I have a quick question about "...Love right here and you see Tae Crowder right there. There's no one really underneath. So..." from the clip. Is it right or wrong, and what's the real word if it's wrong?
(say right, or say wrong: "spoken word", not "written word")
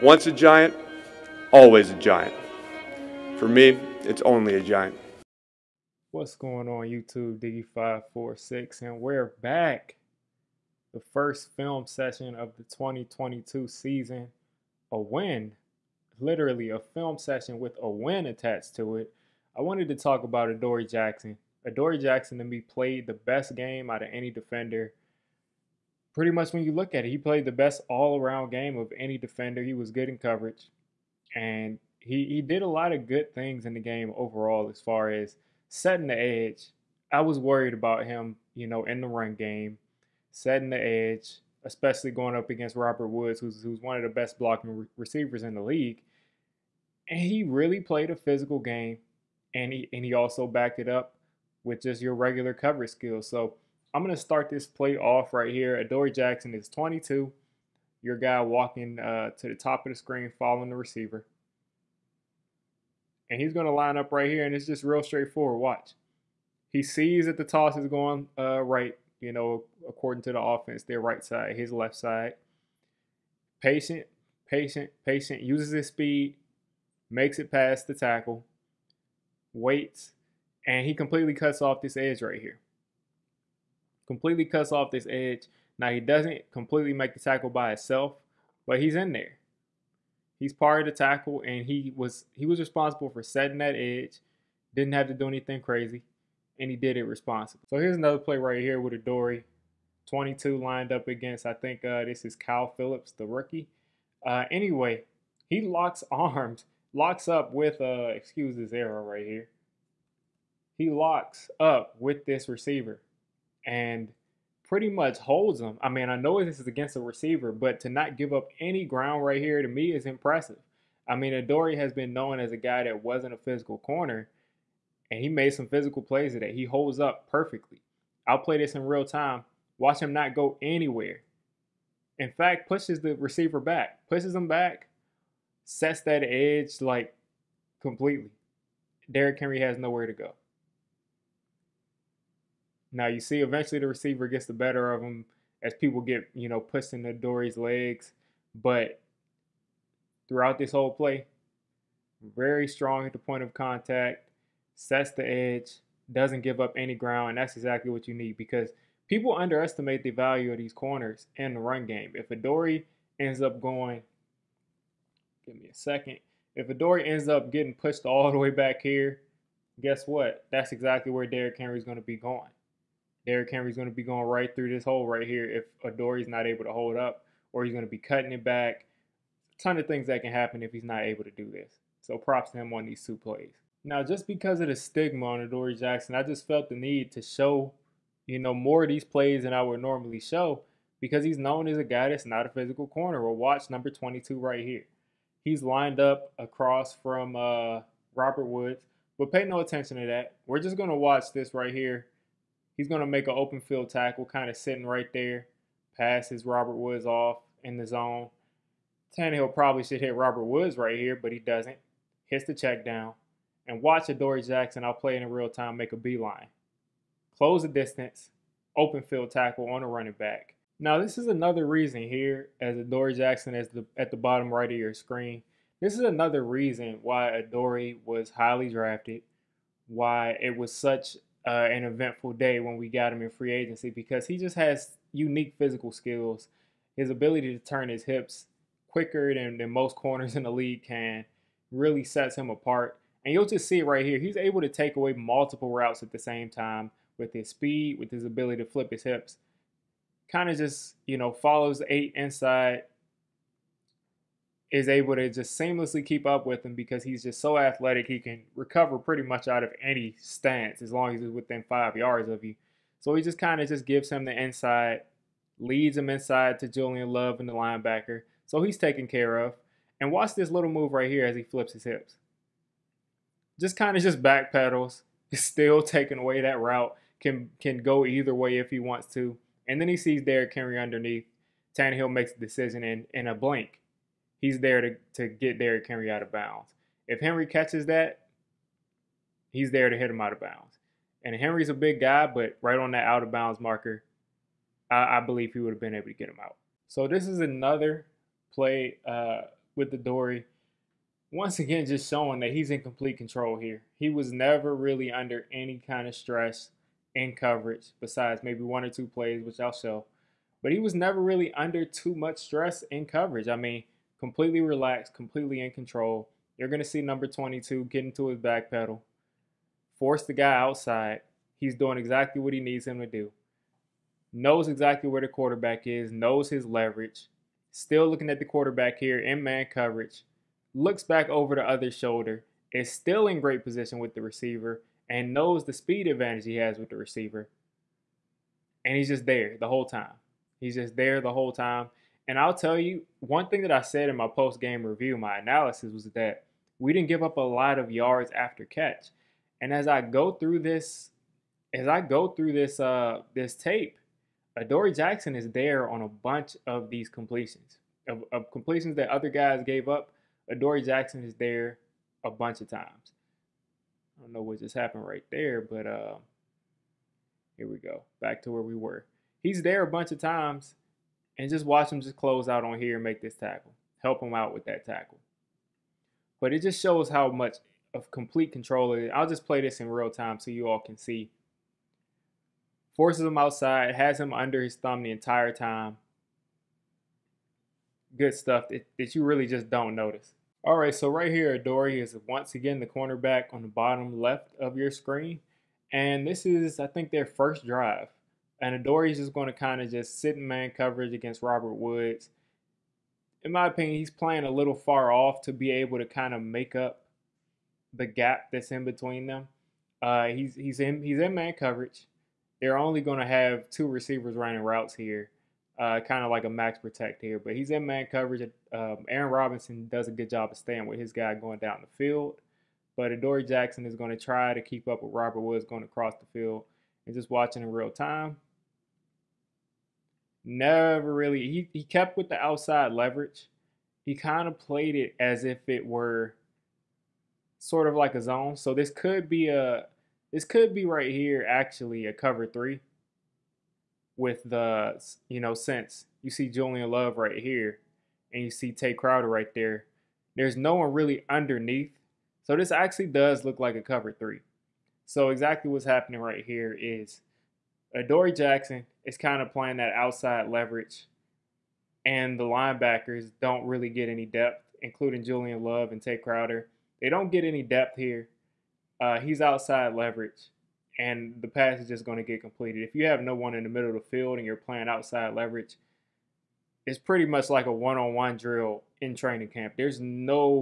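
right.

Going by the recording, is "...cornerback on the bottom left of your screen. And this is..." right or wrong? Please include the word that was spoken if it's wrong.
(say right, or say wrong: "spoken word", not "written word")
right.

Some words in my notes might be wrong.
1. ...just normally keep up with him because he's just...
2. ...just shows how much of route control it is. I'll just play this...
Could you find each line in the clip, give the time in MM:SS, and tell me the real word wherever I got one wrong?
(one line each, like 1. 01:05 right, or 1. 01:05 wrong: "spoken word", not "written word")
1. 04:15 wrong: "seamlessly", not "normally"
2. 06:16 wrong: "complete", not "route".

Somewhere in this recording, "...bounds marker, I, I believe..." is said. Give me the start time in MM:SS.
04:53.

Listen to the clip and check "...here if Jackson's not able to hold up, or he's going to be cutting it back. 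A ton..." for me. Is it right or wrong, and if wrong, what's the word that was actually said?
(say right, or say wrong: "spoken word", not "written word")
wrong: "Adoree", not "Jackson".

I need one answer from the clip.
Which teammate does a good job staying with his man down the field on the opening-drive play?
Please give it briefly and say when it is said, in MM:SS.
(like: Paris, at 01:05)
Aaron Robinson, at 06:59.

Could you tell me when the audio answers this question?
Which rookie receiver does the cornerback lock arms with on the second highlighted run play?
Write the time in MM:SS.
01:42.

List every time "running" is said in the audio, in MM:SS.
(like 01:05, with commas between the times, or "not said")
03:39, 06:54.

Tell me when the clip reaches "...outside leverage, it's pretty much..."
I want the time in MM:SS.
07:54.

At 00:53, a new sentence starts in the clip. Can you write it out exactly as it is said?
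So I'm going to start this play off right here.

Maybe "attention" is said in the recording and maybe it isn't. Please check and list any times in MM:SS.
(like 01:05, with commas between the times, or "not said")
03:19.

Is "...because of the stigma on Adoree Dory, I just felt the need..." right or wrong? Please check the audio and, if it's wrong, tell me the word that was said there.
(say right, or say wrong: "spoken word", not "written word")
wrong: "Jackson", not "Dory".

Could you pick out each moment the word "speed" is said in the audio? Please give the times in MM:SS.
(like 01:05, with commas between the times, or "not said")
01:15, 04:07, 05:35.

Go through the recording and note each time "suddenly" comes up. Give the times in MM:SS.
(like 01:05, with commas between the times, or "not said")
not said.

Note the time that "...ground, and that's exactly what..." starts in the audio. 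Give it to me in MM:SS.
02:36.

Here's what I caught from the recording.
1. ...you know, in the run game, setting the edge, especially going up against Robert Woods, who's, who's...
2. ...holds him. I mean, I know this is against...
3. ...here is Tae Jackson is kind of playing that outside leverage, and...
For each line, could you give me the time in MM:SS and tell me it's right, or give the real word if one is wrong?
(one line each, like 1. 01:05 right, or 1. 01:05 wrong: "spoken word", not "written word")
1. 00:38 right
2. 01:55 right
3. 07:36 wrong: "Dory", not "Tae".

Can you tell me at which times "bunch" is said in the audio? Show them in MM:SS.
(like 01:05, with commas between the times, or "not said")
05:56, 06:02, 06:09.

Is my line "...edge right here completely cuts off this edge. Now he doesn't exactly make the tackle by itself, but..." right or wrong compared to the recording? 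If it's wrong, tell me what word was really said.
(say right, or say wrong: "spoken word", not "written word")
wrong: "completely", not "exactly".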